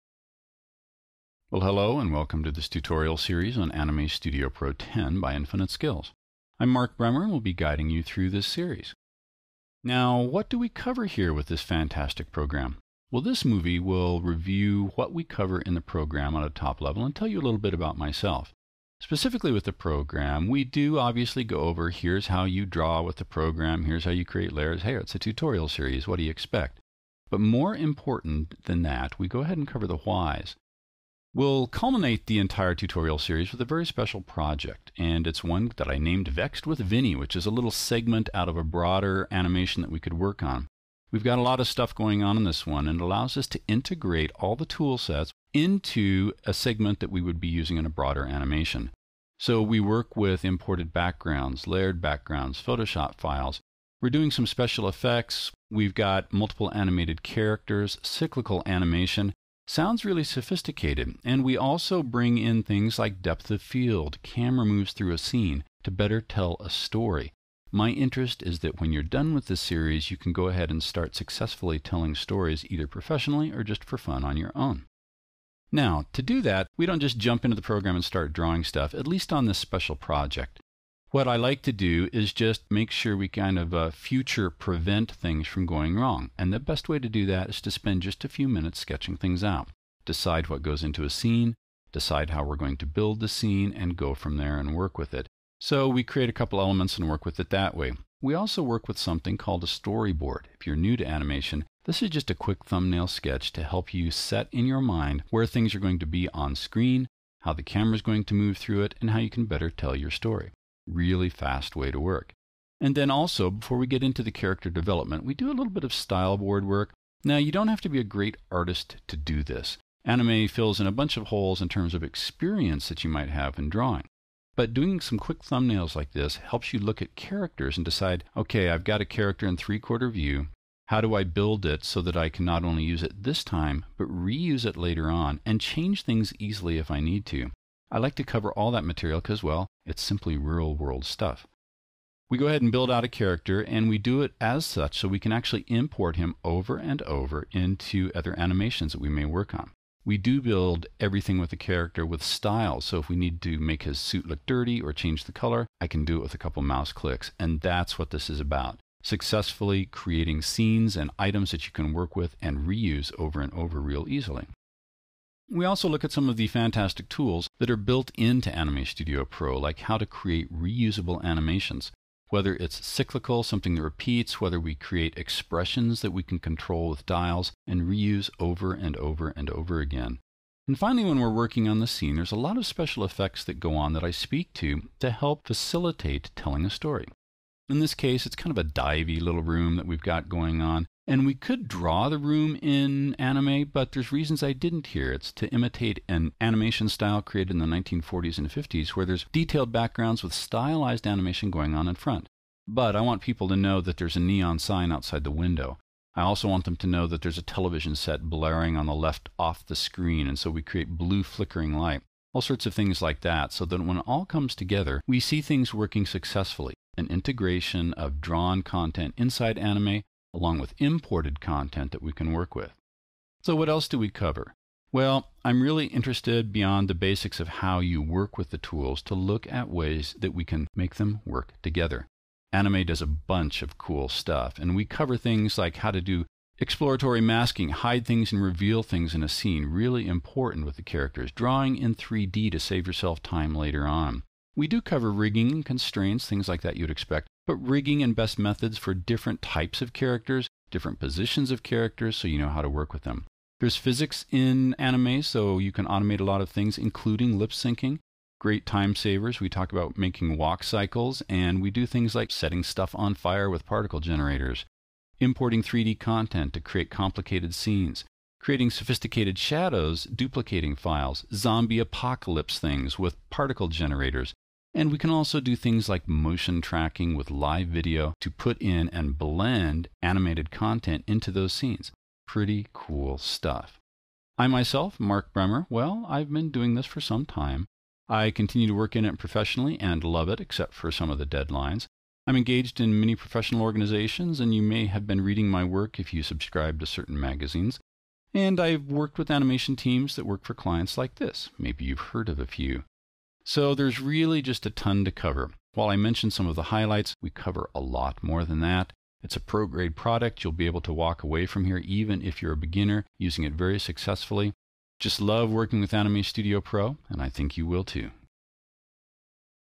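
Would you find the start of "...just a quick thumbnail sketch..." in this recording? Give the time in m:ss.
1:42.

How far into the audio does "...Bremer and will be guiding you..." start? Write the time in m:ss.
0:06.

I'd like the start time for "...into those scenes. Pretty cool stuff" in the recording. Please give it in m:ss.
4:41.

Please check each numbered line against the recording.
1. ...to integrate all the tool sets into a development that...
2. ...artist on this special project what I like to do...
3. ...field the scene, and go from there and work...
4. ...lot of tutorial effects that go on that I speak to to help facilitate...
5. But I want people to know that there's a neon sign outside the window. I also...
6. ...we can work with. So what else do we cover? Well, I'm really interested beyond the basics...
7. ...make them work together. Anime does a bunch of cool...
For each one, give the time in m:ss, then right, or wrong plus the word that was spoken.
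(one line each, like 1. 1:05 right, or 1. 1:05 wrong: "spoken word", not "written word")
1. 0:43 wrong: "segment", not "development"
2. 1:19 wrong: "least", not "artist"
3. 1:32 wrong: "build", not "field"
4. 3:02 wrong: "special", not "tutorial"
5. 3:22 right
6. 3:42 right
7. 3:50 right.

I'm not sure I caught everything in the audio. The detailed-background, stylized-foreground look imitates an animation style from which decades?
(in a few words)
1940s and 50s.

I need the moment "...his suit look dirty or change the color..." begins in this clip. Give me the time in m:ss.
2:33.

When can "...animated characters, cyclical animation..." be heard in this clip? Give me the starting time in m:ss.
0:56.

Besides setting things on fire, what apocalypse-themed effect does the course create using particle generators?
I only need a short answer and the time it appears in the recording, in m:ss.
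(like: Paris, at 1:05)
zombie apocalypse, at 4:31.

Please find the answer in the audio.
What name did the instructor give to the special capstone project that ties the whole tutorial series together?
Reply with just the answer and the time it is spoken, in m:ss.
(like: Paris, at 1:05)
Vexed with Vinny, at 0:36.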